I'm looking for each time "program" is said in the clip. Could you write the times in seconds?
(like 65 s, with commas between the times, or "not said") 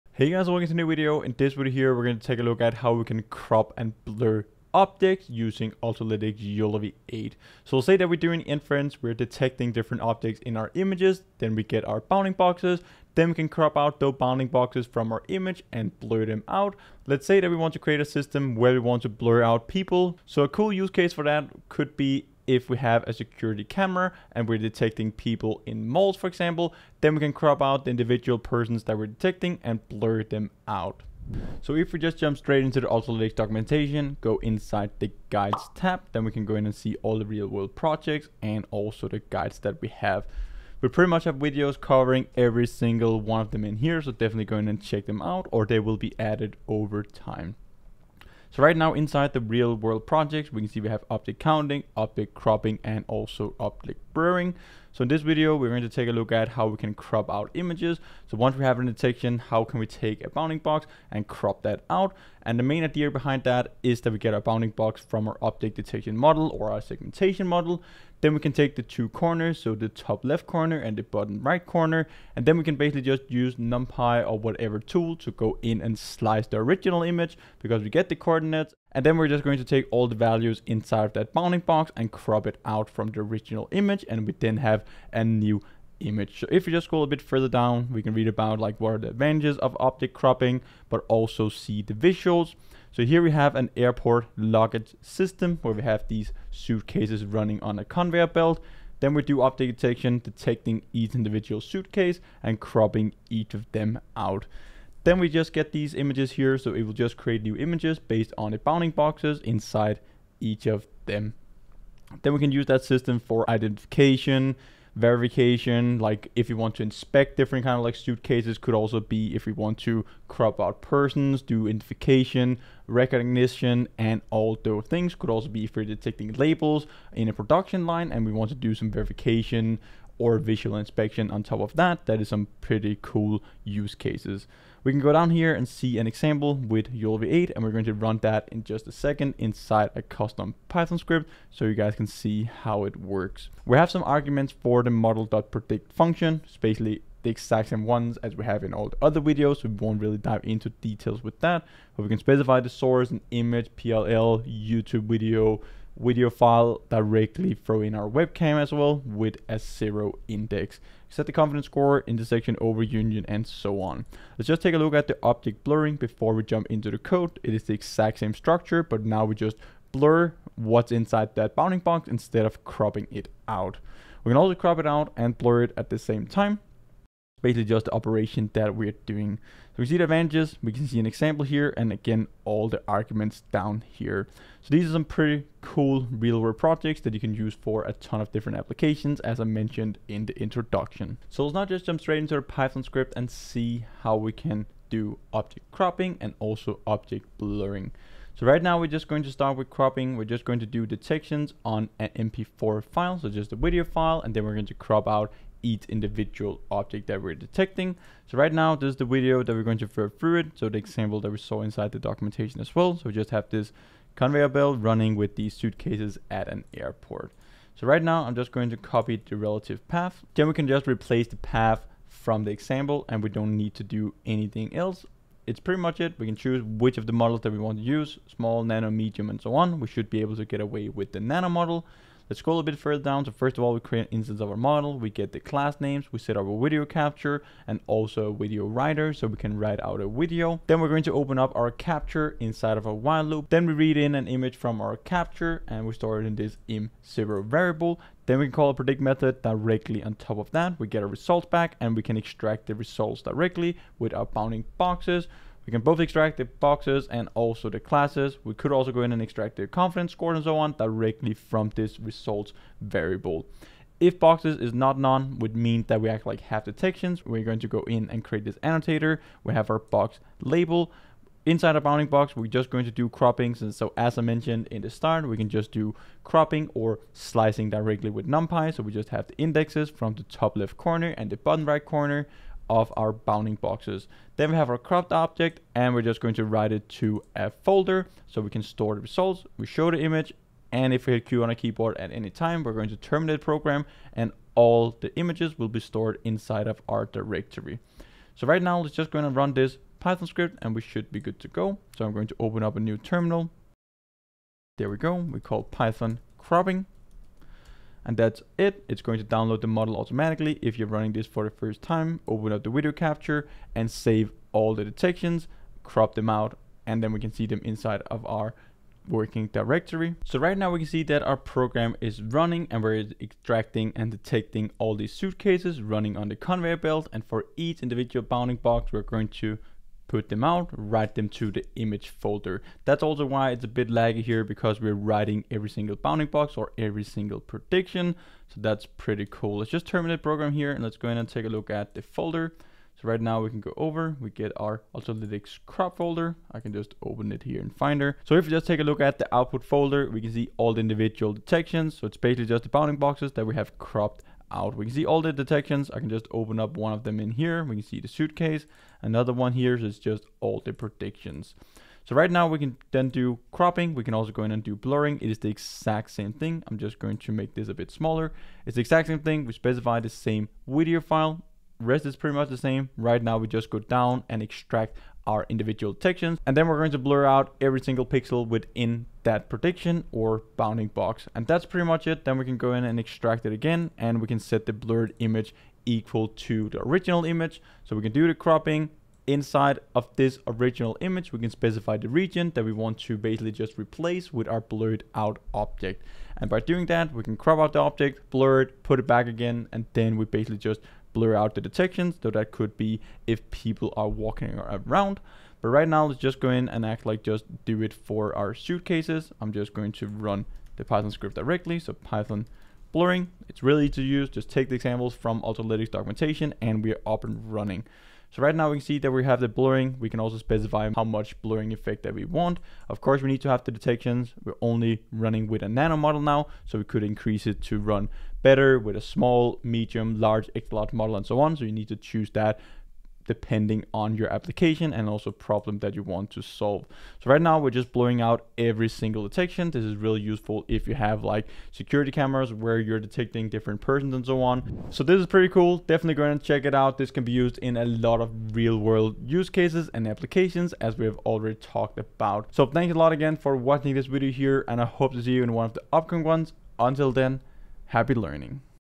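293 s, 321 s, 340 s.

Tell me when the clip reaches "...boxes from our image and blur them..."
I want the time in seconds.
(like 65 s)
14 s.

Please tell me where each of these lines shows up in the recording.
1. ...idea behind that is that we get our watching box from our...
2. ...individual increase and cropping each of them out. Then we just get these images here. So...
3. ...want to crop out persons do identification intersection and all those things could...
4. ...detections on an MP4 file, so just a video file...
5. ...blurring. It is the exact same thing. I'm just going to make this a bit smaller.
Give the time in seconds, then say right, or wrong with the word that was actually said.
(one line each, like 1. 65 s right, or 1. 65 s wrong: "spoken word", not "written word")
1. 62 s wrong: "bounding", not "watching"
2. 101 s wrong: "suitcase", not "increase"
3. 119 s wrong: "recognition", not "intersection"
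4. 200 s right
5. 364 s right.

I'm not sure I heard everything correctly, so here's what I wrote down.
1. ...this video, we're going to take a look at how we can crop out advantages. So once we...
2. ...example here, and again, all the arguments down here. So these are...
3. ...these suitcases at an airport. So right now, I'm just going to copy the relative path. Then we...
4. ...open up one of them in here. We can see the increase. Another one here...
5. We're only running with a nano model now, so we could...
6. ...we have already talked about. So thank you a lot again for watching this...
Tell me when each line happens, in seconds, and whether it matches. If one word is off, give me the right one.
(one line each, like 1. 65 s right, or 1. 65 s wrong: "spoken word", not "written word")
1. 55 s wrong: "images", not "advantages"
2. 181 s right
3. 215 s right
4. 356 s wrong: "suitcase", not "increase"
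5. 424 s right
6. 450 s right.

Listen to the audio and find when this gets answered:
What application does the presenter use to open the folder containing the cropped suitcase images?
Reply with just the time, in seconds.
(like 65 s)
347 s.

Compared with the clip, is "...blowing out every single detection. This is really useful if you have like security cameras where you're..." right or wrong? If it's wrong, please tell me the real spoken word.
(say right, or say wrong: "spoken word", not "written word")
right.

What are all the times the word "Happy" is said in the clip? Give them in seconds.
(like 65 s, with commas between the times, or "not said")
457 s.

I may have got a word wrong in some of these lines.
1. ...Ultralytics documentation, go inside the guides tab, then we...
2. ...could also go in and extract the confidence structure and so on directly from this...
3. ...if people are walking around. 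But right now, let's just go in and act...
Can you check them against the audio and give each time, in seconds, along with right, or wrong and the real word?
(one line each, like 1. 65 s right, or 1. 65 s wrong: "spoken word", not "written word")
1. 32 s right
2. 258 s wrong: "score", not "structure"
3. 403 s right.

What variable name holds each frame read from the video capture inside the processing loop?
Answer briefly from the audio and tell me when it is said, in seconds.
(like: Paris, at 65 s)
im0, at 246 s.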